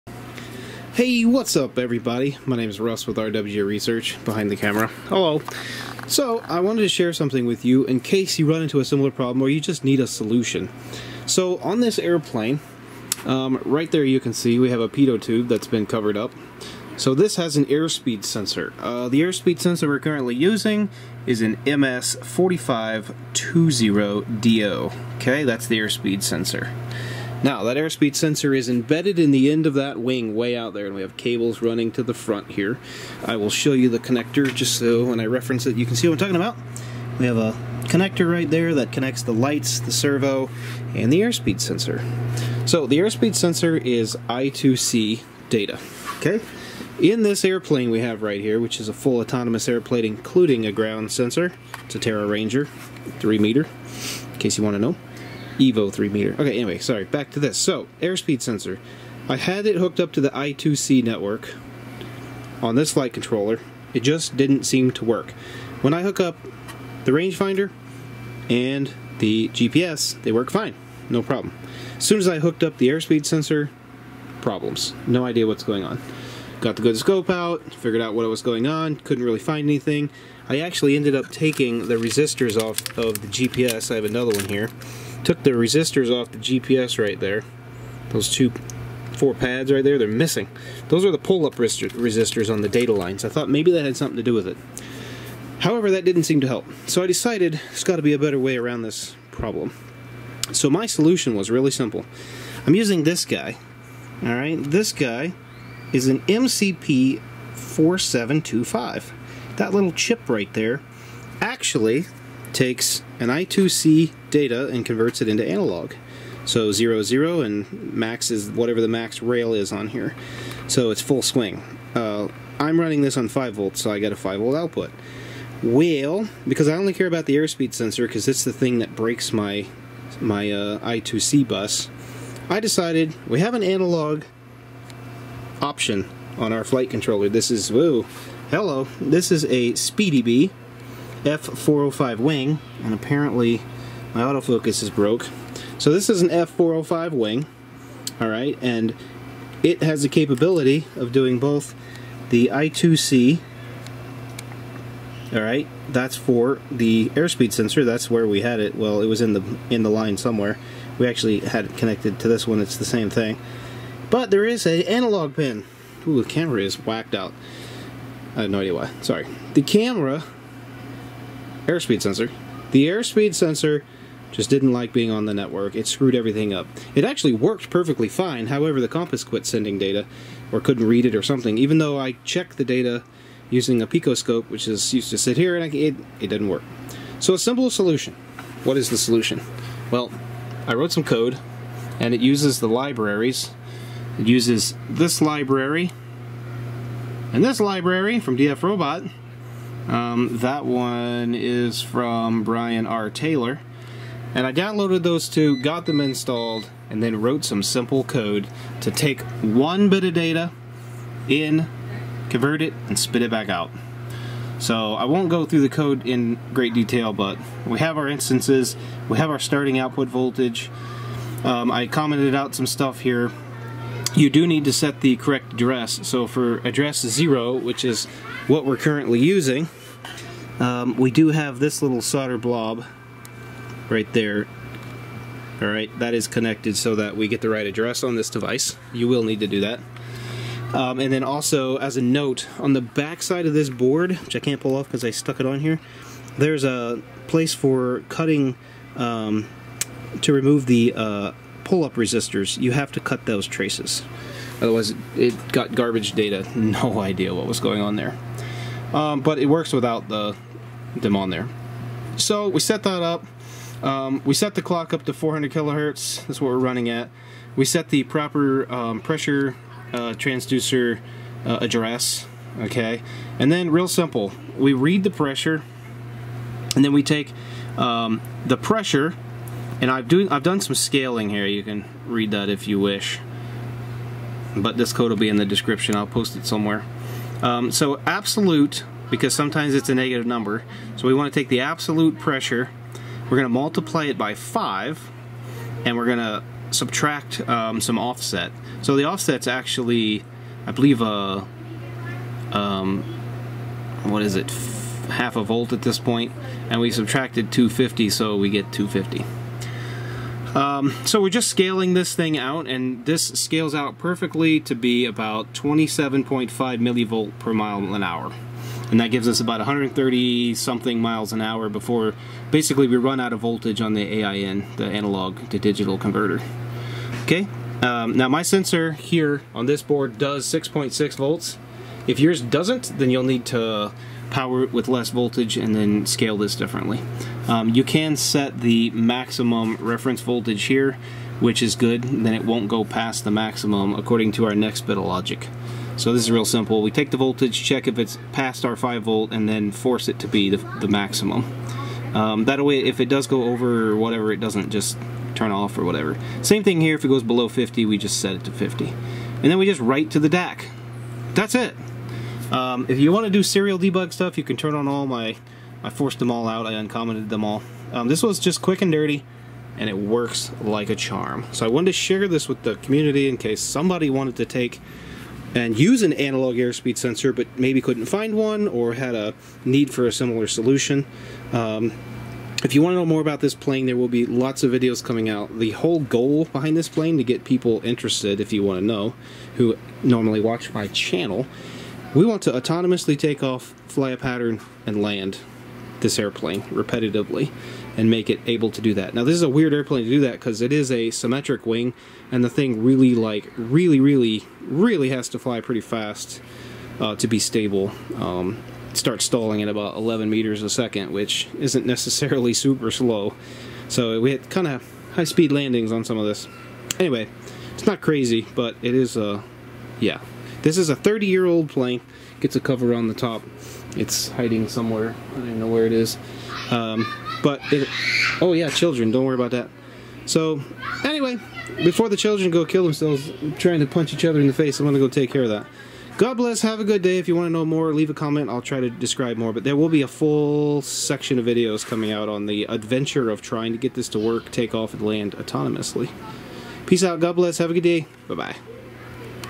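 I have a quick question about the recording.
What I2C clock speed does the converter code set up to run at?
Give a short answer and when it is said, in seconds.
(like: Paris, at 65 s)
400 kilohertz, at 265 s.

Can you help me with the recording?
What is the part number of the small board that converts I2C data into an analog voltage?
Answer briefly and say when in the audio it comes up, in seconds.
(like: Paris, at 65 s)
MCP 4725, at 106 s.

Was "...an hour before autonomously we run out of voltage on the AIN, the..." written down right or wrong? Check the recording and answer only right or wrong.
wrong.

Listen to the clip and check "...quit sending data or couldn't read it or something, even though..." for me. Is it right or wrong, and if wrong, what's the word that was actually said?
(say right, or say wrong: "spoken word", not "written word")
right.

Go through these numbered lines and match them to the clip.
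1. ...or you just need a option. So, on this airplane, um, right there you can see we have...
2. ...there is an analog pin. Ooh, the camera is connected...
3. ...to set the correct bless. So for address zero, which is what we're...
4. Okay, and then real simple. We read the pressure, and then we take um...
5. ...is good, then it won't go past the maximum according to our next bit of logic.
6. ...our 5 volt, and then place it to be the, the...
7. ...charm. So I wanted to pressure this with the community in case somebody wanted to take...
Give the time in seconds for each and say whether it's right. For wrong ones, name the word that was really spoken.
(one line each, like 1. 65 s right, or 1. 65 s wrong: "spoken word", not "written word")
1. 9 s wrong: "solution", not "option"
2. 164 s wrong: "whacked", not "connected"
3. 224 s wrong: "address", not "bless"
4. 272 s right
5. 341 s right
6. 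348 s wrong: "force", not "place"
7. 370 s wrong: "share", not "pressure".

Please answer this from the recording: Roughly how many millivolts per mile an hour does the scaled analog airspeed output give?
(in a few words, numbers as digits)
27.5.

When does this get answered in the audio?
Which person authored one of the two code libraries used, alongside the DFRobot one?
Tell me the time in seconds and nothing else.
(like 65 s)
202 s.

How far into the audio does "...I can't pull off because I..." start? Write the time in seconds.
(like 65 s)
244 s.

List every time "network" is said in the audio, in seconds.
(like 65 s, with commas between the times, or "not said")
61 s, 175 s.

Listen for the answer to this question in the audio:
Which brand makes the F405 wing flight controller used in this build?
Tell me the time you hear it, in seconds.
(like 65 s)
139 s.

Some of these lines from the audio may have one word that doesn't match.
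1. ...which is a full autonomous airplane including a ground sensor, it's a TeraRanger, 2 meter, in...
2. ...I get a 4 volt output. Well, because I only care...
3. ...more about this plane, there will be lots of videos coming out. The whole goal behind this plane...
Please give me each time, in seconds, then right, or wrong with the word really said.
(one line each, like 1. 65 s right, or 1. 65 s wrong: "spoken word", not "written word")
1. 48 s wrong: "3", not "2"
2. 123 s wrong: "5", not "4"
3. 383 s right.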